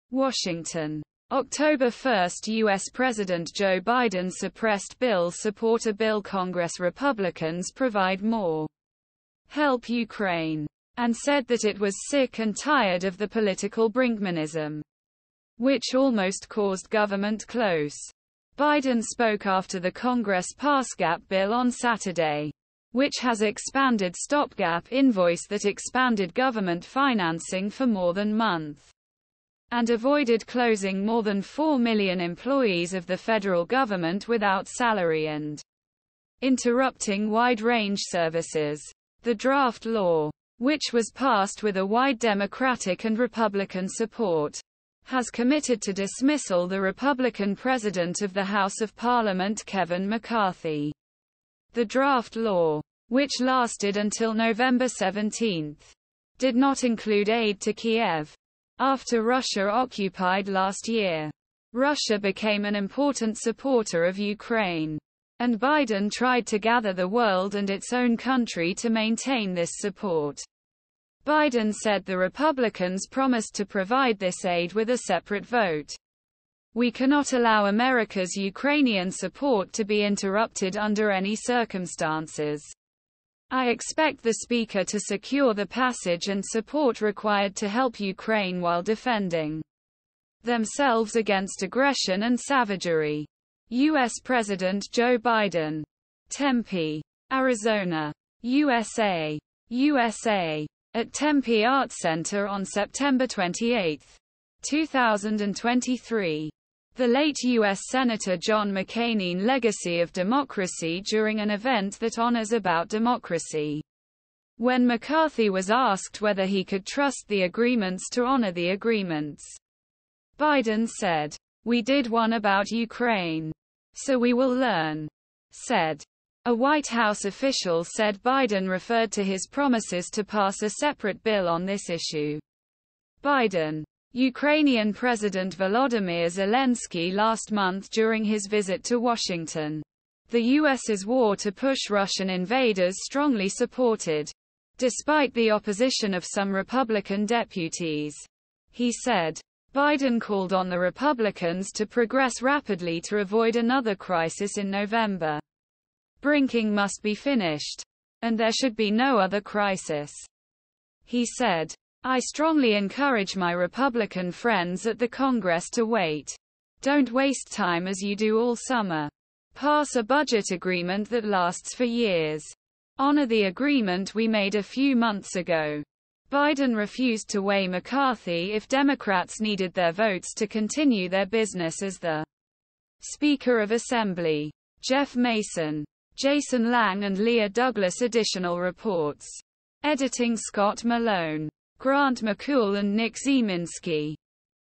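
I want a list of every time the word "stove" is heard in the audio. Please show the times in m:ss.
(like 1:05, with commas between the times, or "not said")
not said.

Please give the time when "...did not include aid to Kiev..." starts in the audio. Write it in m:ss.
0:56.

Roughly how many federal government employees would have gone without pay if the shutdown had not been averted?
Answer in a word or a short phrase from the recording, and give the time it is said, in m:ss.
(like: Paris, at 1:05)
more than 4 million, at 0:31.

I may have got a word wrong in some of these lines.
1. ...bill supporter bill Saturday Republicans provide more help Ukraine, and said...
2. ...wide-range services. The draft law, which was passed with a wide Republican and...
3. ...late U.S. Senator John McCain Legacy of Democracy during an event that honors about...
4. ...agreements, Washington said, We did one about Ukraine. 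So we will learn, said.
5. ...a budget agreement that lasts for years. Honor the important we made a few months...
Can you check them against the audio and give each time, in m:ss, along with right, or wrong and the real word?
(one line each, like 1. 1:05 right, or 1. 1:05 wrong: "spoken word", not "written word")
1. 0:04 wrong: "Congress", not "Saturday"
2. 0:37 wrong: "Democratic", not "Republican"
3. 1:47 right
4. 1:58 wrong: "Biden", not "Washington"
5. 2:49 wrong: "agreement", not "important".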